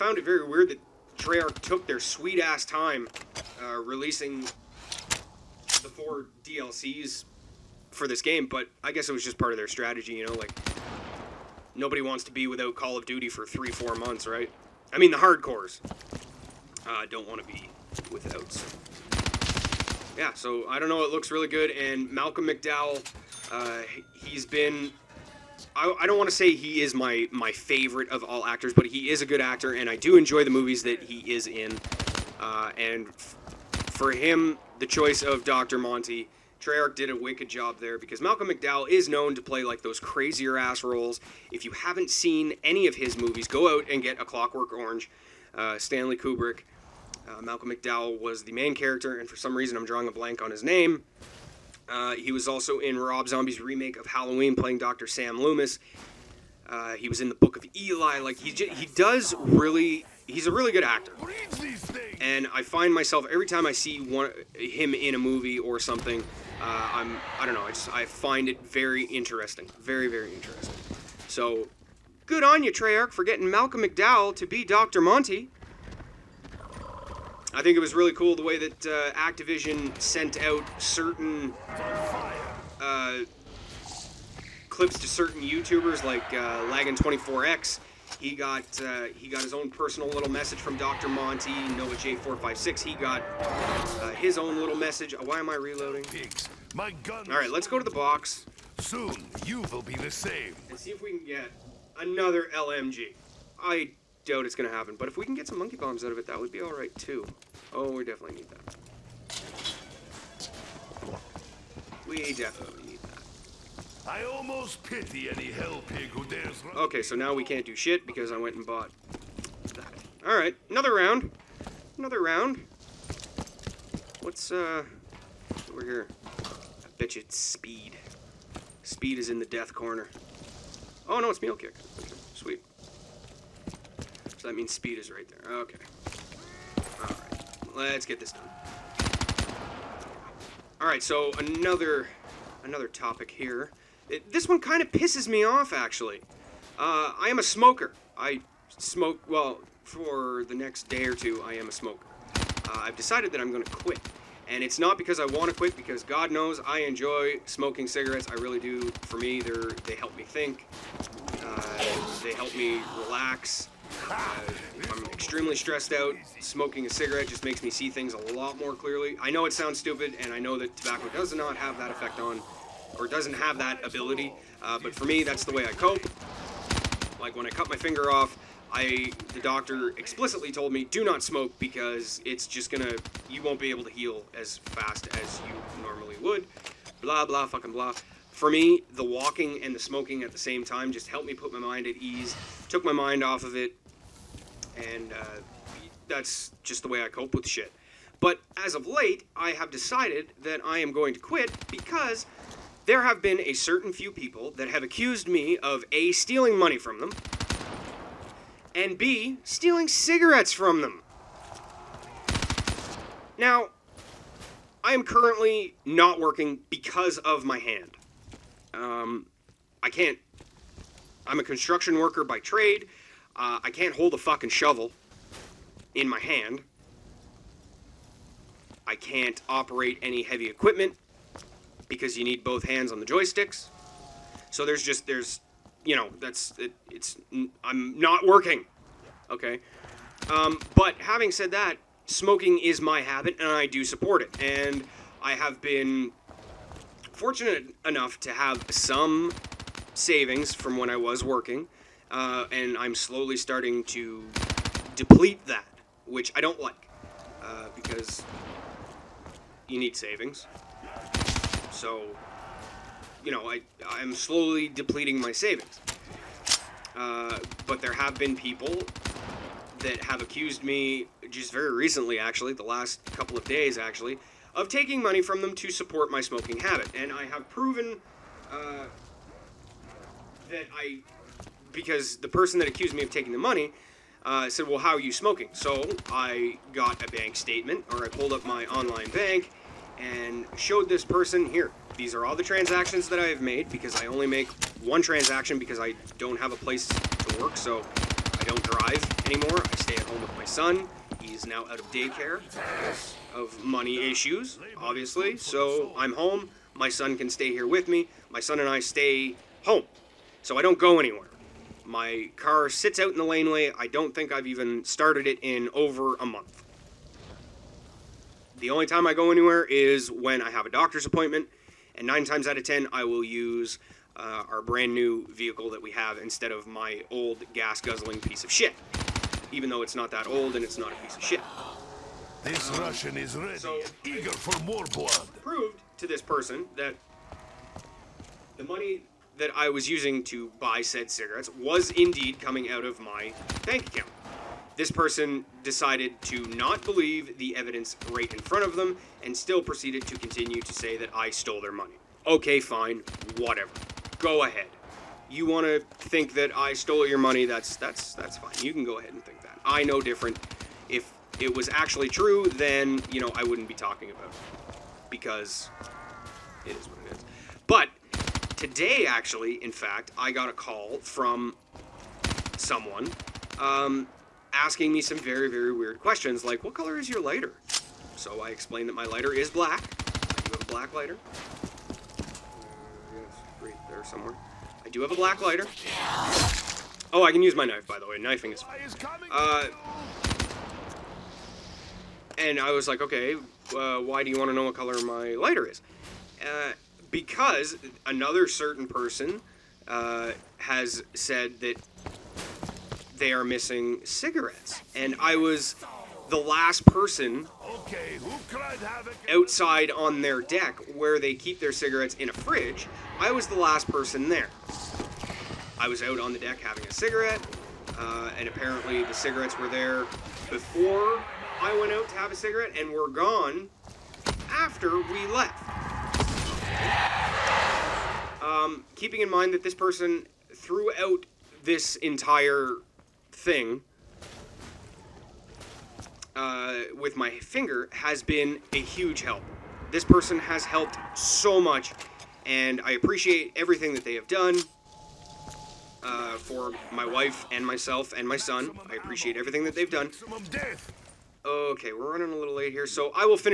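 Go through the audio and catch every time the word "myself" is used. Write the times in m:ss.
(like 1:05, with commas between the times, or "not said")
1:02, 7:27.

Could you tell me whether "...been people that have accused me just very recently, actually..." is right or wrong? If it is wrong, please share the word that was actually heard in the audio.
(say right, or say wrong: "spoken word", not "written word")
right.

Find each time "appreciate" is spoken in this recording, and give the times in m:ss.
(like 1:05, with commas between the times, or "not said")
7:22, 7:28.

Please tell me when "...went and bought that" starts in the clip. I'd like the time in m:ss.
1:58.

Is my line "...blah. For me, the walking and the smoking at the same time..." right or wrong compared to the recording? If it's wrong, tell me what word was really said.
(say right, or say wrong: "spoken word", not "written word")
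right.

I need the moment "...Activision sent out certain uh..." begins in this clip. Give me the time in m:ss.
1:19.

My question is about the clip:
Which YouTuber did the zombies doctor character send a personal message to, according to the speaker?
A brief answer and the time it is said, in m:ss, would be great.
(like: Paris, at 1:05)
NoahJ456, at 1:31.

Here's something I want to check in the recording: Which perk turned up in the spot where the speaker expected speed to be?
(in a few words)
Mule Kick.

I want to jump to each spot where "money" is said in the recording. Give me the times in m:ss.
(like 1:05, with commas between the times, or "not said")
3:26, 4:35, 4:43, 5:03, 5:38, 5:51, 5:57.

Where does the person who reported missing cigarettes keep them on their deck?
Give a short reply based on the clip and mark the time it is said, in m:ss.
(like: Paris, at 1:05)
In a fridge, at 6:52.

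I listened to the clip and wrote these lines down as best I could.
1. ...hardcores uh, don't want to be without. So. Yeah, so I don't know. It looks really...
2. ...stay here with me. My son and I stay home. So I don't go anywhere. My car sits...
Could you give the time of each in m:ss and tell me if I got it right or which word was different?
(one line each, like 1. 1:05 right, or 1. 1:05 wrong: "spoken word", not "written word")
1. 0:15 right
2. 5:07 right.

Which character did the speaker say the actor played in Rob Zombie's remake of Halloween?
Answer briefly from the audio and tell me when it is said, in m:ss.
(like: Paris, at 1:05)
Dr. Sam Loomis, at 0:54.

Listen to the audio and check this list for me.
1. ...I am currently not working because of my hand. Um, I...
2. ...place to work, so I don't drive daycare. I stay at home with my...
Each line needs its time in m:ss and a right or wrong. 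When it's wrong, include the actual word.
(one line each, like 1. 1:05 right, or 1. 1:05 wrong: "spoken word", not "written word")
1. 3:34 right
2. 4:56 wrong: "anymore", not "daycare".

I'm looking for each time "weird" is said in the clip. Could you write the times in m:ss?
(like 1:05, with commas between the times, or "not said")
0:00, 6:15.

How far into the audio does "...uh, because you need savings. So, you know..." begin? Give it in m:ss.
4:17.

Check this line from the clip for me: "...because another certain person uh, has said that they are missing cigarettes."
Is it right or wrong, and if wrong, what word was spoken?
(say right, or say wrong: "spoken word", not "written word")
right.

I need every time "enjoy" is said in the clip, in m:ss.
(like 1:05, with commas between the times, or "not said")
0:30, 2:36.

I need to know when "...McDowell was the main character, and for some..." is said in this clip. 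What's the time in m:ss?
0:47.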